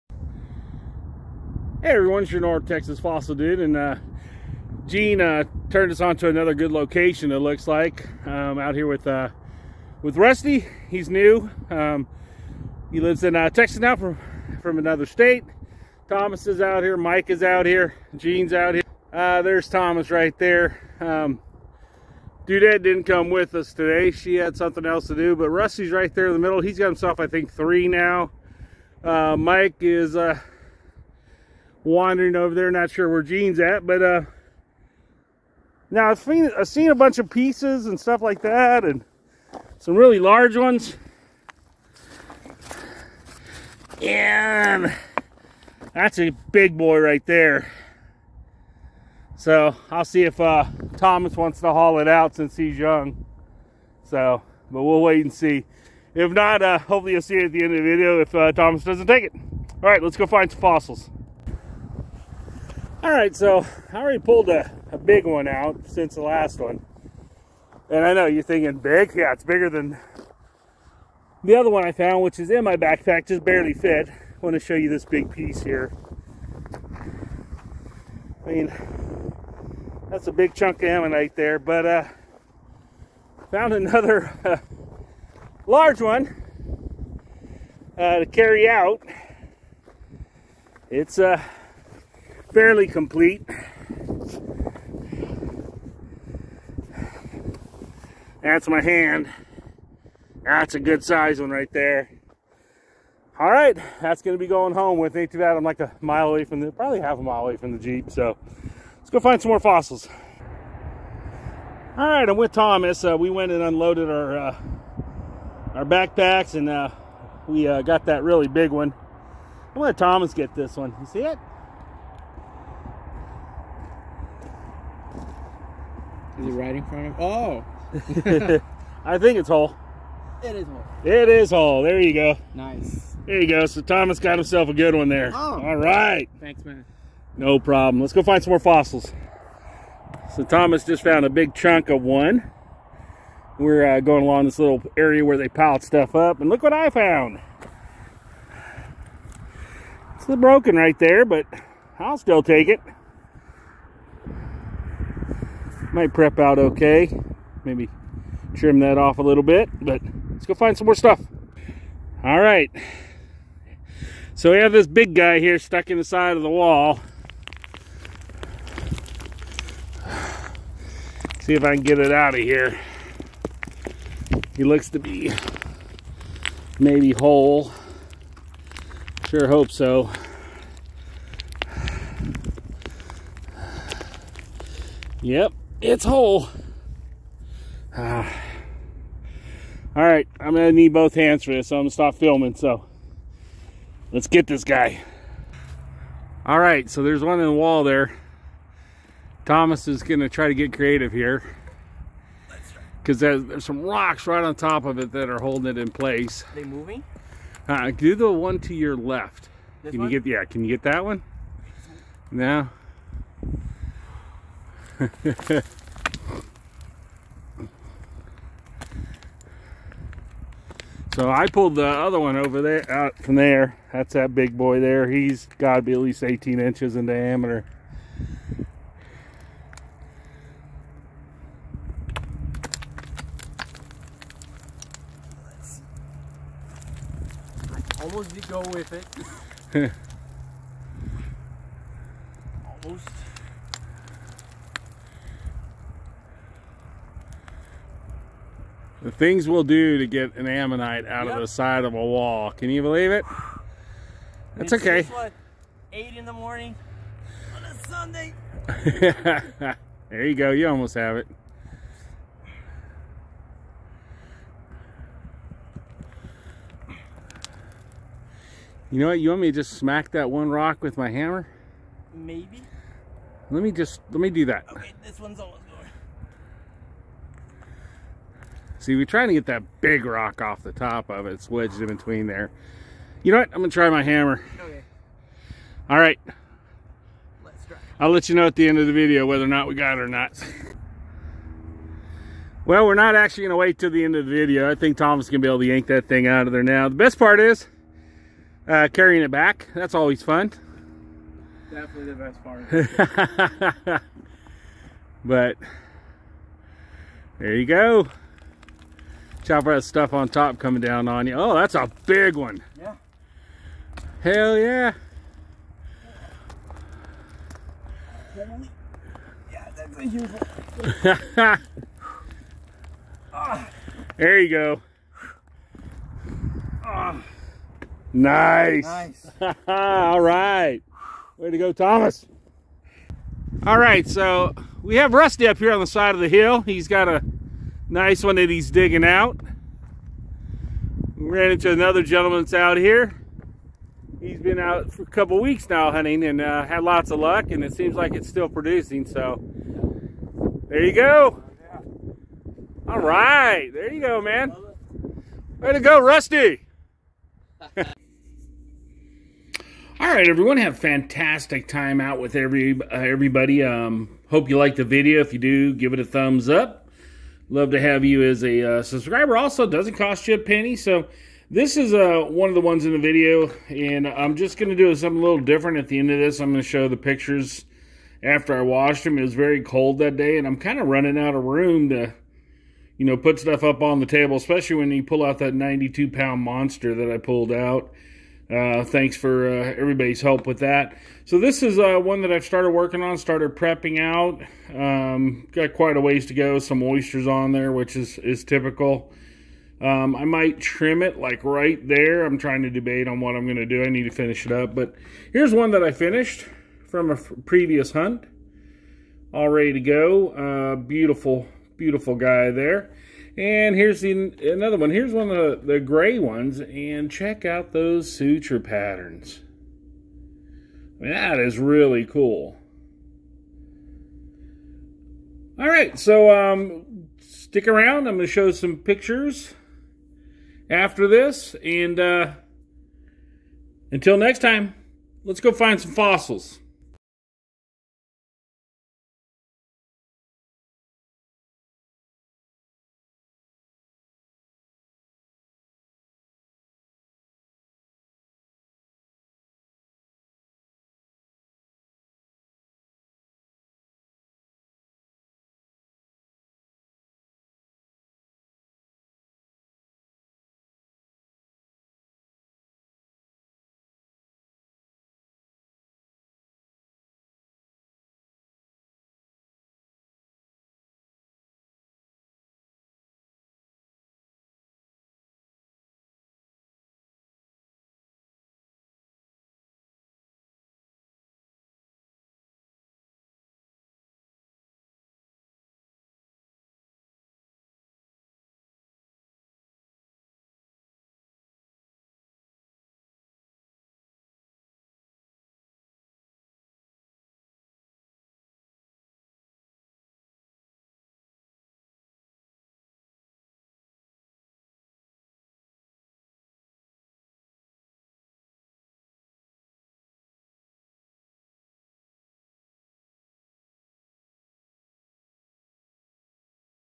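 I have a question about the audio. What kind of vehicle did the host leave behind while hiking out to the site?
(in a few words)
Jeep.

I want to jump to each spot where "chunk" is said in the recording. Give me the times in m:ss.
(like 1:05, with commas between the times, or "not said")
1:20, 2:21.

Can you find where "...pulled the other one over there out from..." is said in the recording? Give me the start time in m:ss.
3:41.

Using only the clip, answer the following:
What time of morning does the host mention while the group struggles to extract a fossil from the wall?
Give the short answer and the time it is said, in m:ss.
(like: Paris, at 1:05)
8 in the morning, at 4:15.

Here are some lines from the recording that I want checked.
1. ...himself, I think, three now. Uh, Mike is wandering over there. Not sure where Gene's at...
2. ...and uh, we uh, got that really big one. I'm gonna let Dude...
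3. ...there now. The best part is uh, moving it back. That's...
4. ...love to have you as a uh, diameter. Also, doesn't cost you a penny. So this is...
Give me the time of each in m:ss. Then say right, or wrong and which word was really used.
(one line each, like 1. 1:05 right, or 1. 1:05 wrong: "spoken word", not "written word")
1. 0:26 right
2. 1:56 wrong: "Thomas", not "Dude"
3. 4:56 wrong: "carrying", not "moving"
4. 6:07 wrong: "subscriber", not "diameter".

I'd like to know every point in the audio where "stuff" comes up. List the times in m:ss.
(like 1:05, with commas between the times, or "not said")
0:37, 2:25, 2:40, 5:09, 6:23.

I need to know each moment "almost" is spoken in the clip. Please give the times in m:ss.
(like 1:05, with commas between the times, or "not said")
3:58, 4:02, 4:20, 4:35.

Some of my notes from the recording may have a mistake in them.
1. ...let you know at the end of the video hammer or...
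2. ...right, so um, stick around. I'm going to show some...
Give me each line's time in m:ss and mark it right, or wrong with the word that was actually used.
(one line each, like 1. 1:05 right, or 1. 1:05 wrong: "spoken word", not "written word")
1. 4:48 wrong: "whether", not "hammer"
2. 7:05 right.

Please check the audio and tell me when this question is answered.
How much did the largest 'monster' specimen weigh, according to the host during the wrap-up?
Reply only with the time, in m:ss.
6:25.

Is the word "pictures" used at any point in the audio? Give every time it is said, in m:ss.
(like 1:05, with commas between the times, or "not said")
6:16, 7:08.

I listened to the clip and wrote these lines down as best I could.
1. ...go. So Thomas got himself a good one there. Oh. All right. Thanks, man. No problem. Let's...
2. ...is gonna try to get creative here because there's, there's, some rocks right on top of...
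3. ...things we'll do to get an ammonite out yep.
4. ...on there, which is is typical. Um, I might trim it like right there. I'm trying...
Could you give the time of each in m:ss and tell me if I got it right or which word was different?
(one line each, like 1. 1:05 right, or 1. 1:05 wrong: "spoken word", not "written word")
1. 2:13 right
2. 3:19 right
3. 4:09 right
4. 6:37 right.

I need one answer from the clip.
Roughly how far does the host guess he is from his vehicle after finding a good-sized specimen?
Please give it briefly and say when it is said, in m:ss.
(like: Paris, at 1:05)
half a mile, at 1:47.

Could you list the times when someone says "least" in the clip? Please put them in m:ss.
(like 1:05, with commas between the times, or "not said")
3:45.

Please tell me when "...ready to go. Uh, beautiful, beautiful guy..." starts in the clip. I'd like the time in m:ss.
6:49.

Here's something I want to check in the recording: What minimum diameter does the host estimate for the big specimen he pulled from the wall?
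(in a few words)
18 inches.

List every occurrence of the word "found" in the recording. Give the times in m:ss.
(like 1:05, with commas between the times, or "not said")
1:11, 1:23, 2:21, 2:26.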